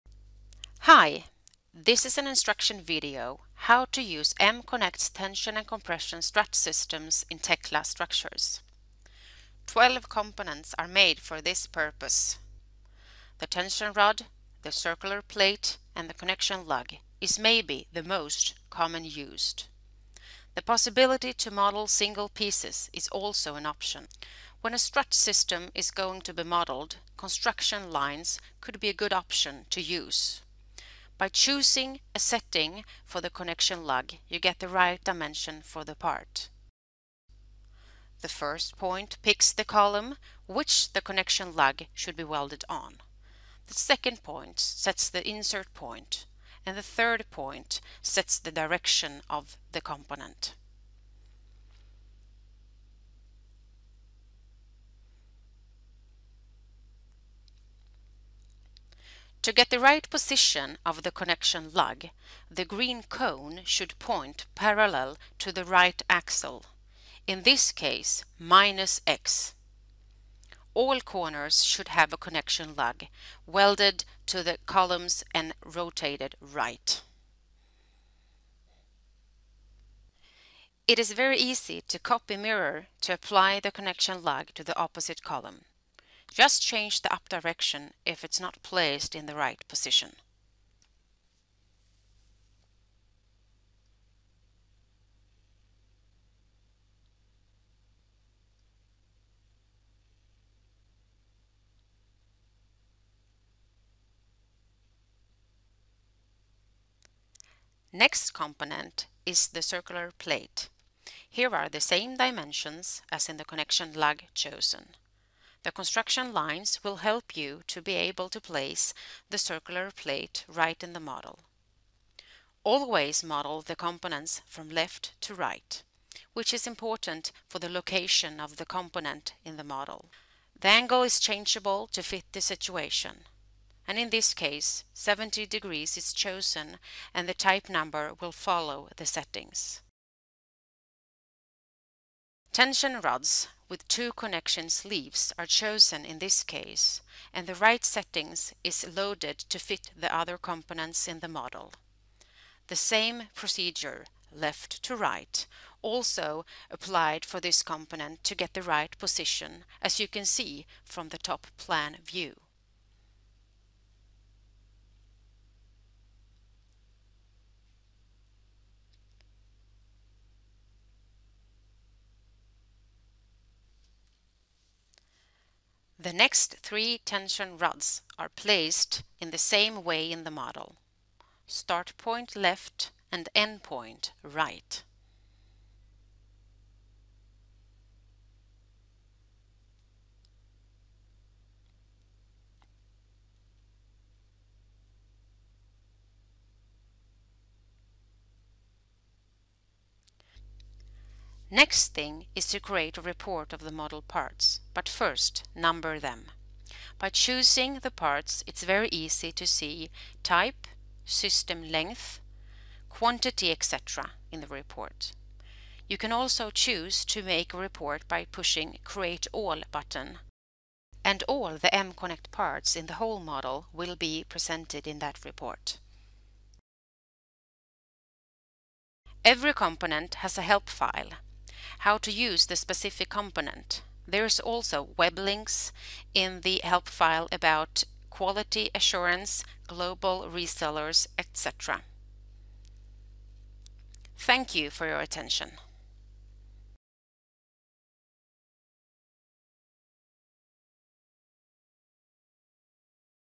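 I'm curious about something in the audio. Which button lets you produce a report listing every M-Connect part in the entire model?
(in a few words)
Create All.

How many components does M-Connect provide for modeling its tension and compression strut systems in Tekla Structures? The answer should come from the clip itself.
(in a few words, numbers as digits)
12.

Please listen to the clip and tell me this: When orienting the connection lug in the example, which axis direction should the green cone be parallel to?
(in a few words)
minus x.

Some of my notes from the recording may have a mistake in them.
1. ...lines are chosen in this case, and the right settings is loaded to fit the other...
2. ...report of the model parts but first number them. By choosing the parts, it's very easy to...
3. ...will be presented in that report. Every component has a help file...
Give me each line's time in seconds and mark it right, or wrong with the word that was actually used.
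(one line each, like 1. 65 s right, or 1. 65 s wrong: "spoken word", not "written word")
1. 144 s wrong: "leaves", not "lines"
2. 203 s right
3. 223 s right.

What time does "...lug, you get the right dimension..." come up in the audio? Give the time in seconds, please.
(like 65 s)
33 s.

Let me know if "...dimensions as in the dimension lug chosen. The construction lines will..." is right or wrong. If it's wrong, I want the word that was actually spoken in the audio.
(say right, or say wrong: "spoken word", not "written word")
wrong: "connection", not "dimension".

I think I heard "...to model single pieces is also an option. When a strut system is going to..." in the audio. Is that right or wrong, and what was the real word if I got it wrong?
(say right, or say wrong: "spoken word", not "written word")
right.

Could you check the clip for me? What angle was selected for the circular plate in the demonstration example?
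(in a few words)
70 degrees.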